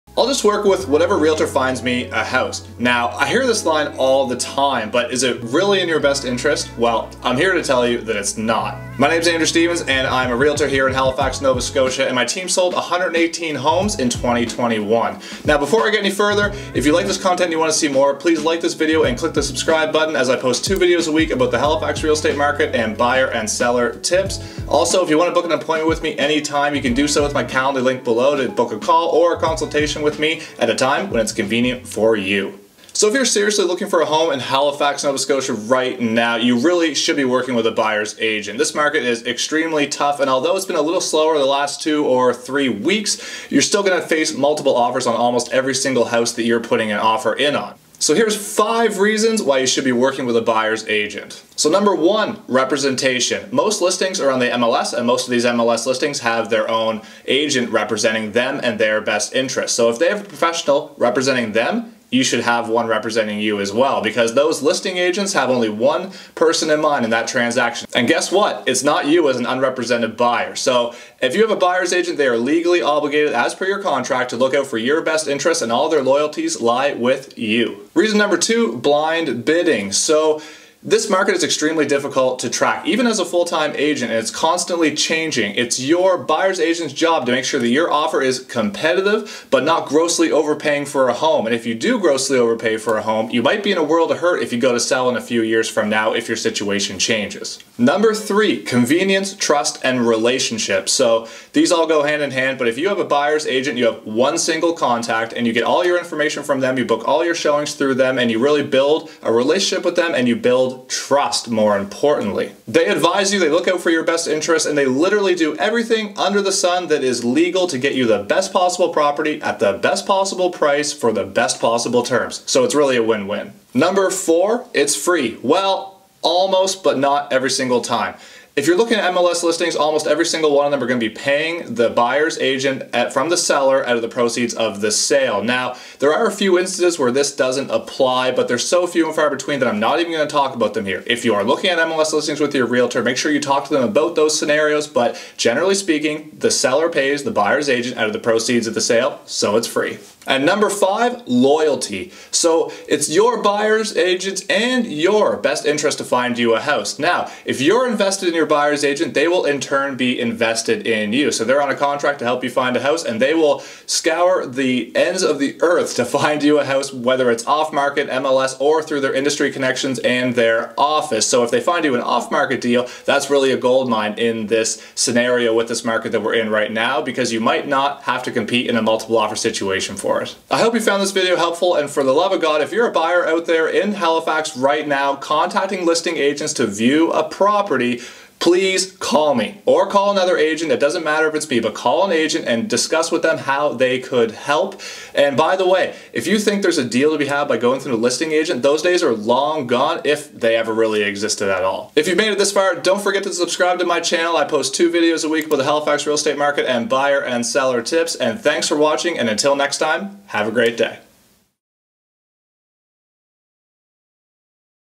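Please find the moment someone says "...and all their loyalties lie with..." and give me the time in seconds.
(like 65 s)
75 s.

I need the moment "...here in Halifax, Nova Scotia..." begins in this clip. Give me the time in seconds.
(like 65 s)
10 s.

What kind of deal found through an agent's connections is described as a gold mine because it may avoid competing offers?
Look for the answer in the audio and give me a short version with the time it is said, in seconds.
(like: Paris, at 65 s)
Off market deal, at 172 s.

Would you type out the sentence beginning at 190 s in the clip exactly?
It doesn't matter if it's me, but call an agent and discuss with them how they could help.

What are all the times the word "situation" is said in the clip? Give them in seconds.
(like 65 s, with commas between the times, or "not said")
96 s, 179 s.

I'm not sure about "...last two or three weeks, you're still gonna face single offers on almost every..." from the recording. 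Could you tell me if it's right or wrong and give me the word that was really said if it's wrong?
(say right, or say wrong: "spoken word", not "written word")
wrong: "multiple", not "single".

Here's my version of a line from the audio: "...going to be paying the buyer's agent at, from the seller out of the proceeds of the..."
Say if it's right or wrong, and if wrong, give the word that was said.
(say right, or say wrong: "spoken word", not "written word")
right.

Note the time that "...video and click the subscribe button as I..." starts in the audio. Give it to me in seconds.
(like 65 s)
18 s.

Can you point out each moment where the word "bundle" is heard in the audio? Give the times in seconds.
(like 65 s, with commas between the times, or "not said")
not said.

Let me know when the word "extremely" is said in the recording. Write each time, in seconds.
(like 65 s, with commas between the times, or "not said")
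39 s, 81 s.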